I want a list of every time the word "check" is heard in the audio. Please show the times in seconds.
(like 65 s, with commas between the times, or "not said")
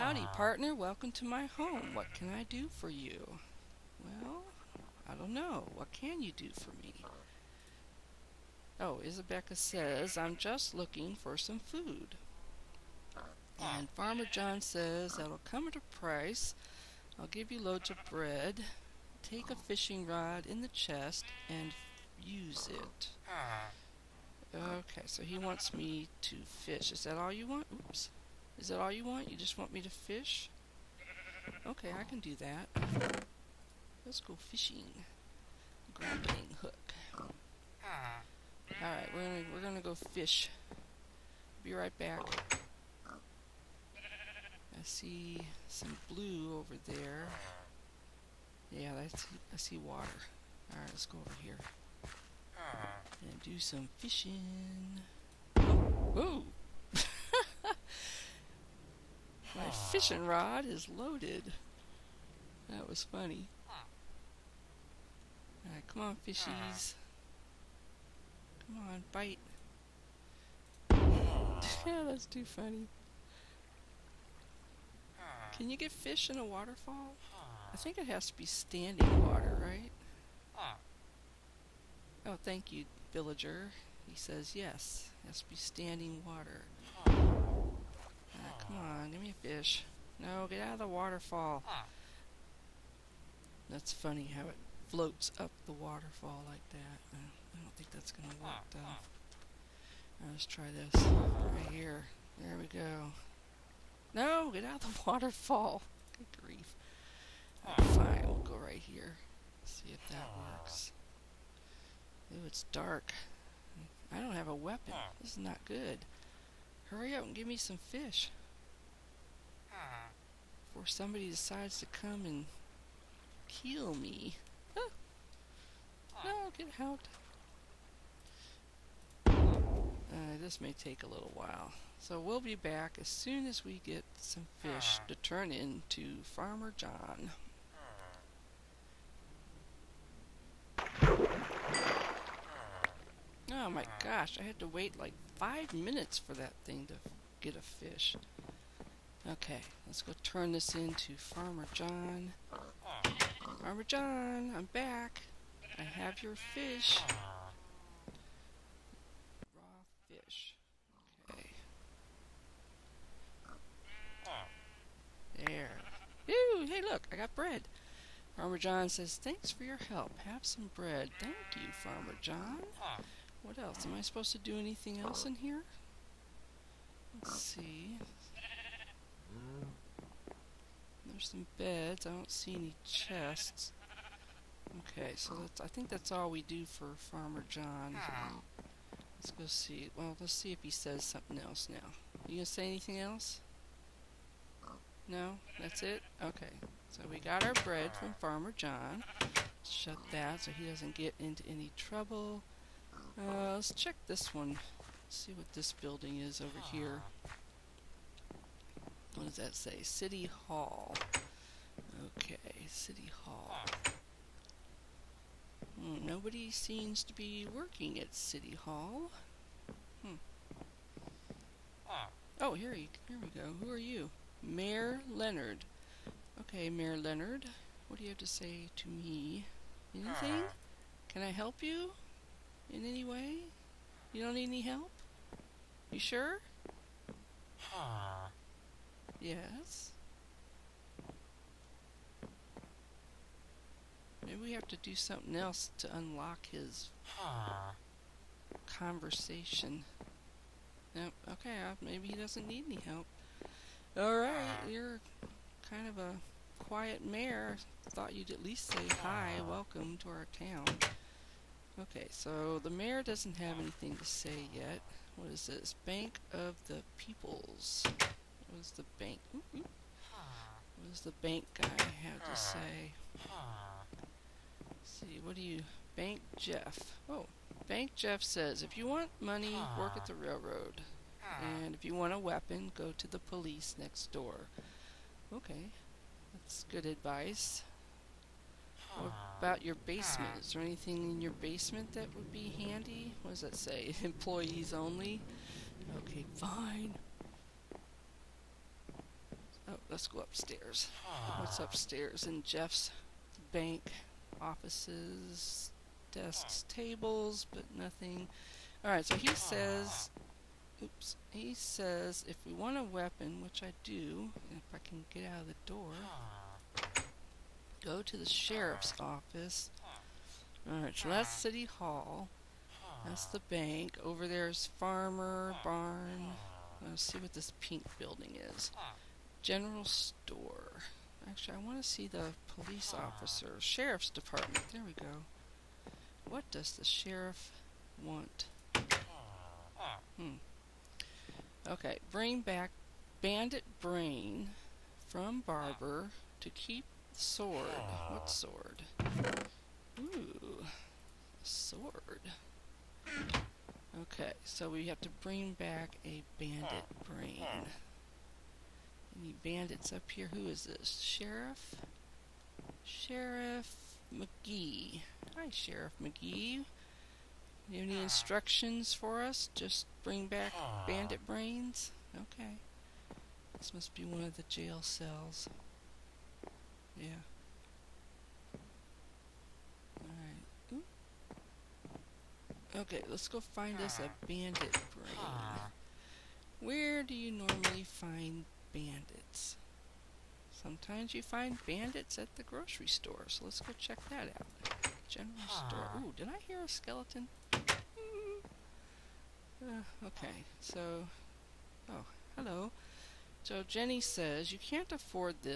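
203 s, 393 s.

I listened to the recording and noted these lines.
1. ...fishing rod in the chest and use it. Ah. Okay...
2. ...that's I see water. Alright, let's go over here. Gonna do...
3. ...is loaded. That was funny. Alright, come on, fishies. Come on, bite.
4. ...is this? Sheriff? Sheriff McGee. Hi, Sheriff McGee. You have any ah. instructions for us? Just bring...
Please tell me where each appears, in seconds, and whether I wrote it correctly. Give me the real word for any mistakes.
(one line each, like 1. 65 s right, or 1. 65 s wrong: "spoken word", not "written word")
1. 19 s right
2. 49 s right
3. 60 s right
4. 360 s right.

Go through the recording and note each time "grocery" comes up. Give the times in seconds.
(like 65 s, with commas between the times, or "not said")
392 s.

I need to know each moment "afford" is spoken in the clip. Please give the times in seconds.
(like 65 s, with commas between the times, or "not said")
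404 s.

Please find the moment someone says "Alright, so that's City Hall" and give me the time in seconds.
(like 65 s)
320 s.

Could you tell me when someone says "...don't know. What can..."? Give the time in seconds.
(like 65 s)
5 s.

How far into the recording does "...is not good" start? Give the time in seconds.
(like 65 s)
115 s.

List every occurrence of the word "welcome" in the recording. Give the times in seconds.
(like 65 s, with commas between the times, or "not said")
0 s, 259 s.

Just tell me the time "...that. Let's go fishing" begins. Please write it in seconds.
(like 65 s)
32 s.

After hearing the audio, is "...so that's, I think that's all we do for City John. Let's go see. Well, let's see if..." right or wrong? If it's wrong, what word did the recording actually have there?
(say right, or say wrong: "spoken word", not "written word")
wrong: "Farmer", not "City".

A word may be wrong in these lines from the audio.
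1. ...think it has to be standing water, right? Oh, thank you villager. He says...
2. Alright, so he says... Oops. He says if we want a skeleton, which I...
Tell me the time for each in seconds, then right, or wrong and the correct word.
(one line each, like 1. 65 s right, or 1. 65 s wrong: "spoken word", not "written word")
1. 77 s right
2. 308 s wrong: "weapon", not "skeleton".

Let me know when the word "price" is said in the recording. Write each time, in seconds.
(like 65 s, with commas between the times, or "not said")
15 s.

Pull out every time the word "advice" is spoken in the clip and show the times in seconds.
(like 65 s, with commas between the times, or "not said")
286 s.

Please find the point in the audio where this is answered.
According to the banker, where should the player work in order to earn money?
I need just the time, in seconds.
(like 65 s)
279 s.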